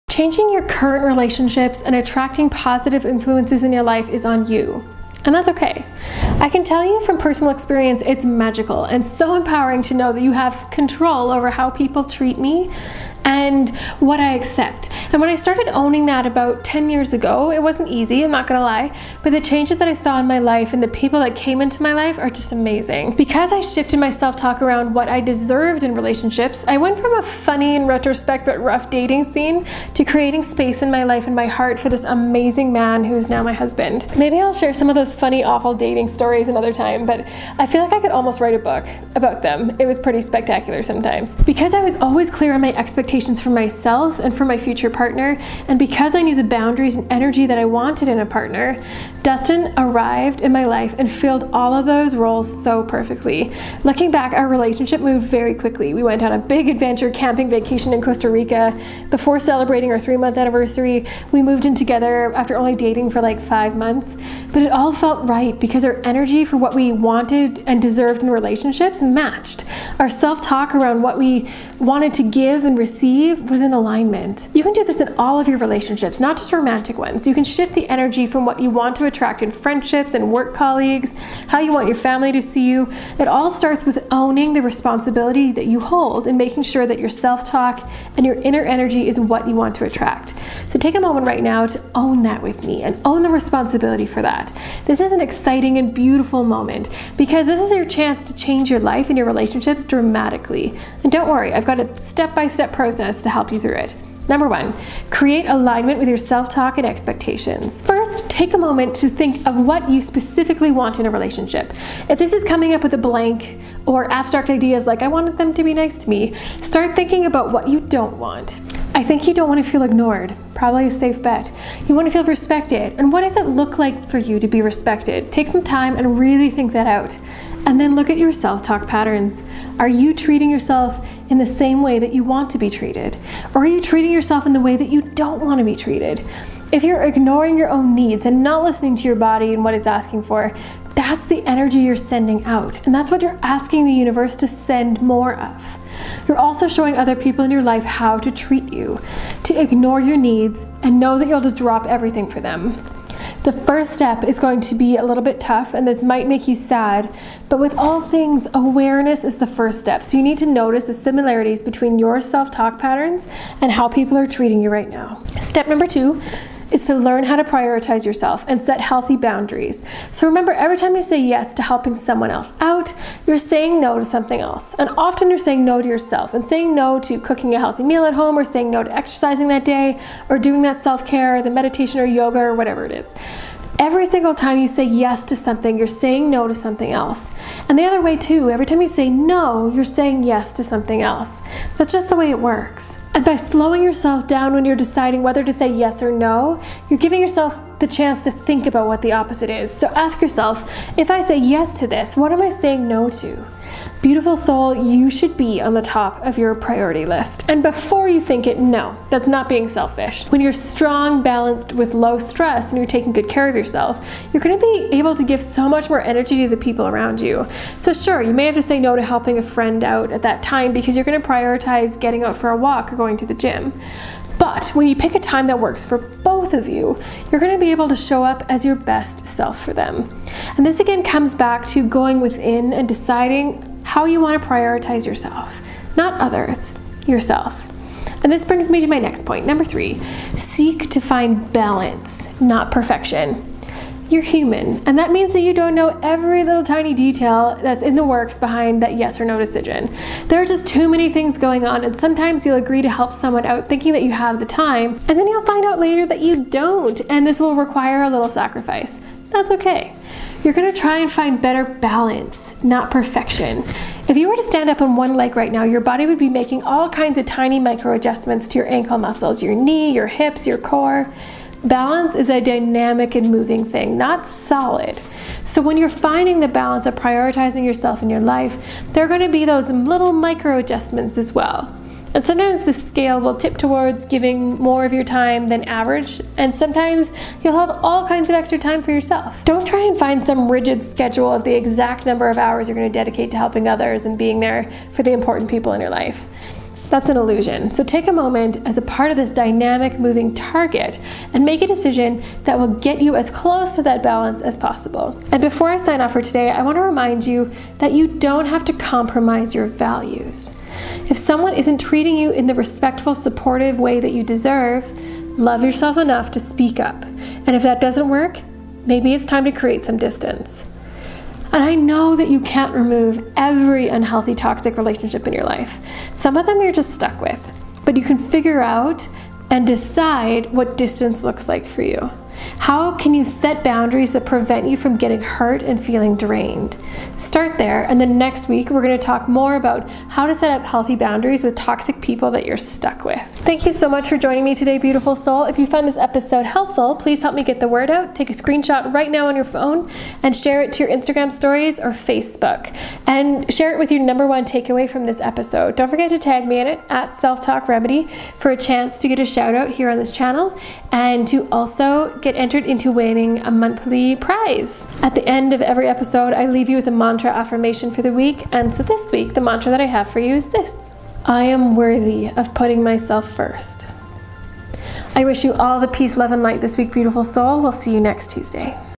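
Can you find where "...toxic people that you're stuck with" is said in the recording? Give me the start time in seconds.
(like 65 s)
341 s.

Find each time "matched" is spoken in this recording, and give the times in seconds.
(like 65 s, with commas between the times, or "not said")
69 s.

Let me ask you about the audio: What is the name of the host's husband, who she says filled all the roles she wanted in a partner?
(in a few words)
Dustin.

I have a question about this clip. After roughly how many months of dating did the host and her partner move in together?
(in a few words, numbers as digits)
5 months.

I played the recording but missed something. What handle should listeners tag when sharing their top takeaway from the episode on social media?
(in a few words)
Self Talk Remedy.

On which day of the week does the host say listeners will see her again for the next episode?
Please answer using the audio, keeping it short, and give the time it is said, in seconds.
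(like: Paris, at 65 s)
Tuesday, at 378 s.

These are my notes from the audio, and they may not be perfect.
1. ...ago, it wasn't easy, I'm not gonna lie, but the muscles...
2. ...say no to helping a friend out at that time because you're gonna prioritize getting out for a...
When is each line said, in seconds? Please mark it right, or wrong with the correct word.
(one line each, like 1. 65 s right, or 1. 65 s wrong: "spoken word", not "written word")
1. 17 s wrong: "changes", not "muscles"
2. 218 s right.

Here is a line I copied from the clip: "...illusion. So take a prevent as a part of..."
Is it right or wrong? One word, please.
wrong.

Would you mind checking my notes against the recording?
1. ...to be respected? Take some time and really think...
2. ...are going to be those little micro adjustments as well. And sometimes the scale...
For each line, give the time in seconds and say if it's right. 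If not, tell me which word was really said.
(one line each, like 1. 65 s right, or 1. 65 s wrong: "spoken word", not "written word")
1. 124 s right
2. 279 s right.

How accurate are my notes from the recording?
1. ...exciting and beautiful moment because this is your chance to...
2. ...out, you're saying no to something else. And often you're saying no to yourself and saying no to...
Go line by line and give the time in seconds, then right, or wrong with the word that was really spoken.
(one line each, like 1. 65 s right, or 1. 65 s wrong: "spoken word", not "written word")
1. 95 s right
2. 172 s right.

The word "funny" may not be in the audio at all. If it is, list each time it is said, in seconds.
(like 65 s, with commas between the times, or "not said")
27 s, 35 s.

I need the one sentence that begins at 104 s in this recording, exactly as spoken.
Number one, create alignment with your self-talk and expectations.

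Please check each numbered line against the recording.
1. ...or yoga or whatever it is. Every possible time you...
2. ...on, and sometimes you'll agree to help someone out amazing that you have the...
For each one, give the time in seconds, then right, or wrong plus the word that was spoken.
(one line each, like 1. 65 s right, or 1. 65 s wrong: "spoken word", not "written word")
1. 181 s wrong: "single", not "possible"
2. 251 s wrong: "thinking", not "amazing".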